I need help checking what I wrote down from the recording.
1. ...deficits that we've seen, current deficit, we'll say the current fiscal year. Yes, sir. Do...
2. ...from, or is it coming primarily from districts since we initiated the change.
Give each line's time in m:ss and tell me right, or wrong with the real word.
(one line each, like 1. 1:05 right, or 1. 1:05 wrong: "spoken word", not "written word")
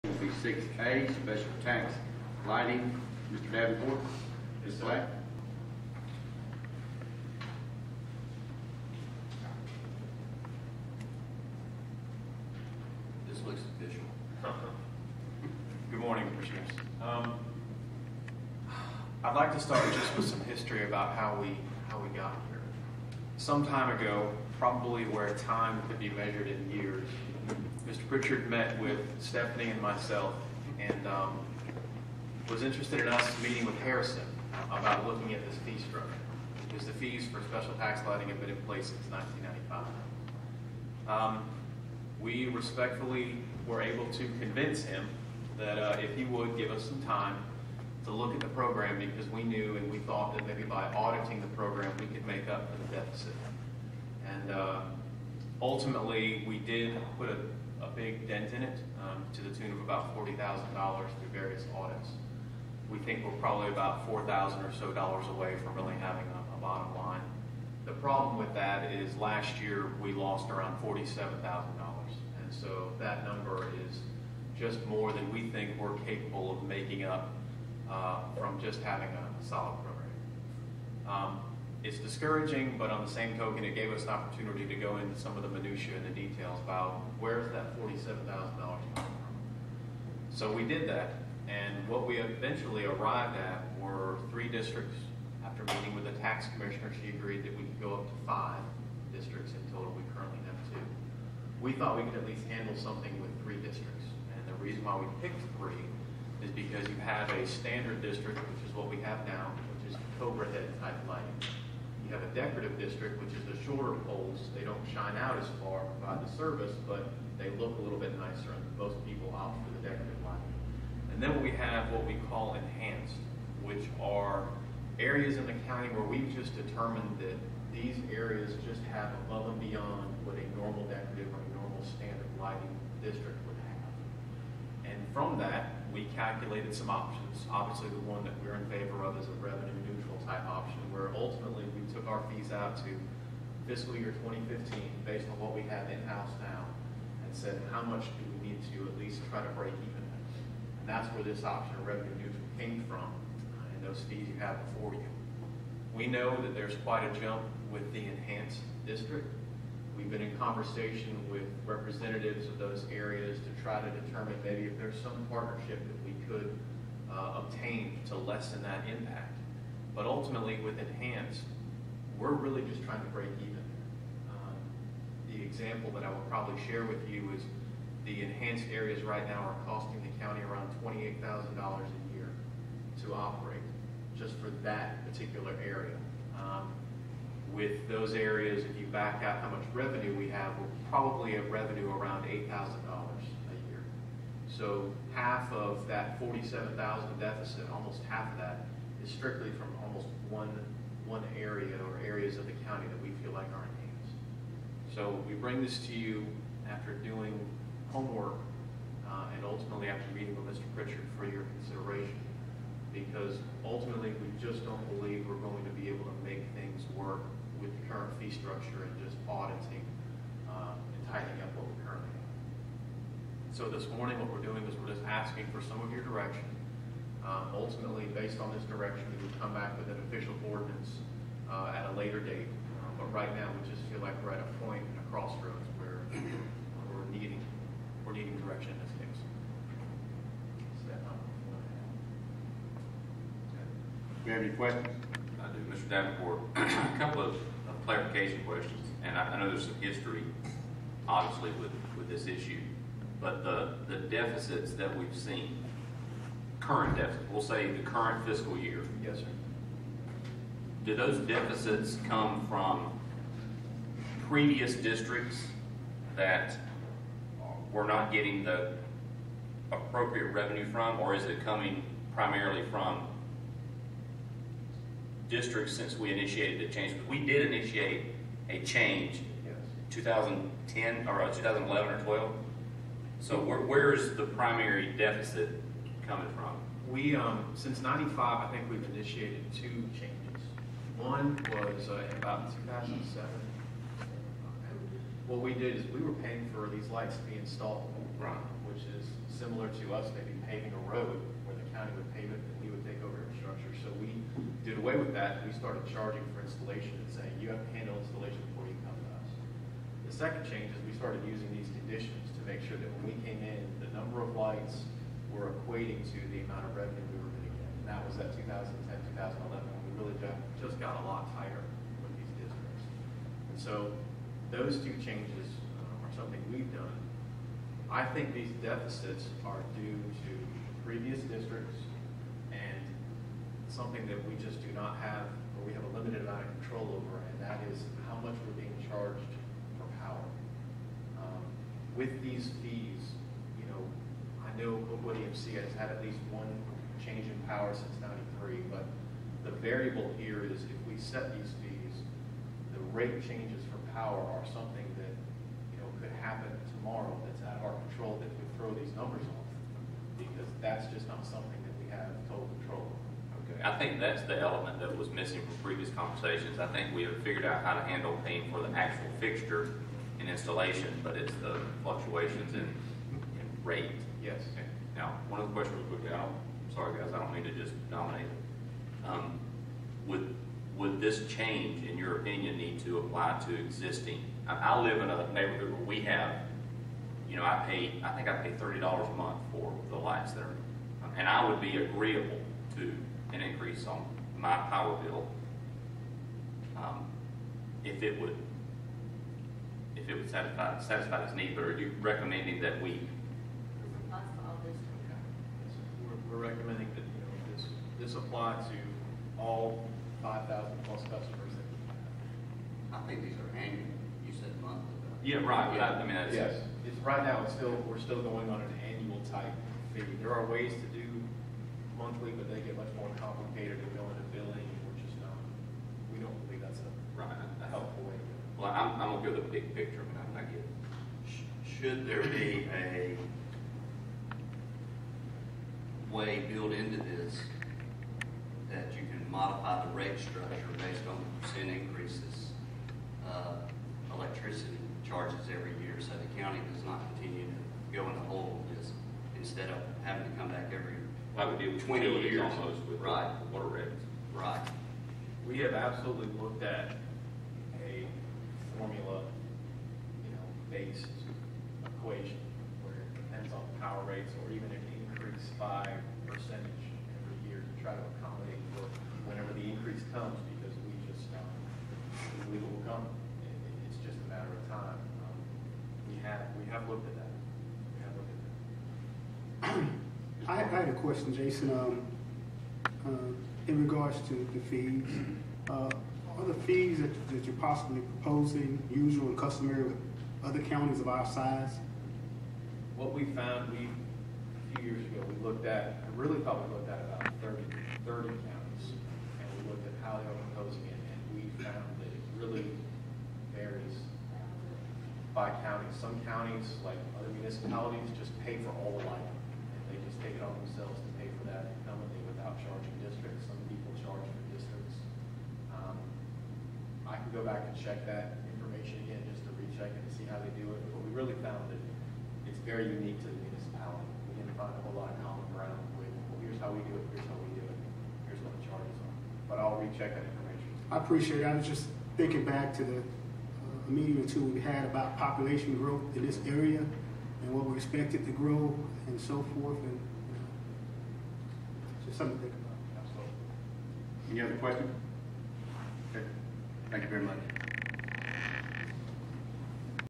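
1. 4:13 right
2. 4:30 right.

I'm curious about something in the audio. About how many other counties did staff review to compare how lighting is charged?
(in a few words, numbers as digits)
30.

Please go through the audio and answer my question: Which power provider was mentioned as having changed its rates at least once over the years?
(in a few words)
Colquitt EMC.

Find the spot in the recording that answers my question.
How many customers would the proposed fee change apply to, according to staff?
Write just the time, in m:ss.
6:50.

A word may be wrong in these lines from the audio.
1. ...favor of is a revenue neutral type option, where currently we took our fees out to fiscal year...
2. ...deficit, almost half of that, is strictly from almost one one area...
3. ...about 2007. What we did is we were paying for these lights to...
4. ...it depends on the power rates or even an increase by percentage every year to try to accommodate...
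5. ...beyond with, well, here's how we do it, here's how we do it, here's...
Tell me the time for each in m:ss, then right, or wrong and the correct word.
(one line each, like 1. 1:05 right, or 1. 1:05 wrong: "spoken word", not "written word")
1. 2:18 wrong: "ultimately", not "currently"
2. 3:17 right
3. 4:52 right
4. 7:42 right
5. 8:45 wrong: "ground", not "beyond".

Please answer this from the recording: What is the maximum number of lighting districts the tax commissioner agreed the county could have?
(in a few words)
5.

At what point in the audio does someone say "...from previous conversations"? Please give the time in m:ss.
6:05.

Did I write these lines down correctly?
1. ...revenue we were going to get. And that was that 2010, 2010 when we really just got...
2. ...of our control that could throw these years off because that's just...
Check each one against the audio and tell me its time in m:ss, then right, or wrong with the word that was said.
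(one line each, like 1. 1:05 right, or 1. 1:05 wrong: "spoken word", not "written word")
1. 5:16 wrong: "2011", not "2010"
2. 5:57 wrong: "numbers", not "years".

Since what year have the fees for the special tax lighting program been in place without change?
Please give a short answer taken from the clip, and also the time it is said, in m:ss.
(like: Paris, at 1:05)
1995, at 0:39.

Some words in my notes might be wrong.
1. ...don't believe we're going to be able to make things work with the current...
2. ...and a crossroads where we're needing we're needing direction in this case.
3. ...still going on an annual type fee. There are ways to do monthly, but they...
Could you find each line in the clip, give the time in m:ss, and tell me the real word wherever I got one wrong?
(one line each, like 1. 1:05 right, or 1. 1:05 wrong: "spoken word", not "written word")
1. 3:34 right
2. 3:54 right
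3. 6:57 right.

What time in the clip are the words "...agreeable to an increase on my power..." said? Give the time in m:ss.
6:31.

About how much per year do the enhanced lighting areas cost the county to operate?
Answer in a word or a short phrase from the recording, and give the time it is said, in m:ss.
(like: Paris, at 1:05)
$28,000, at 3:00.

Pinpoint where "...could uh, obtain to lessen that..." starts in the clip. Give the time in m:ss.
2:46.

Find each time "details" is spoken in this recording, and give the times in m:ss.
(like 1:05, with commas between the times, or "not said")
1:26.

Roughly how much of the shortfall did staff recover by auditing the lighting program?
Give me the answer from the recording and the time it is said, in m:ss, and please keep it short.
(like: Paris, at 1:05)
$40,000, at 1:00.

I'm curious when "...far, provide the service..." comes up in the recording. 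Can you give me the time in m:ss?
1:55.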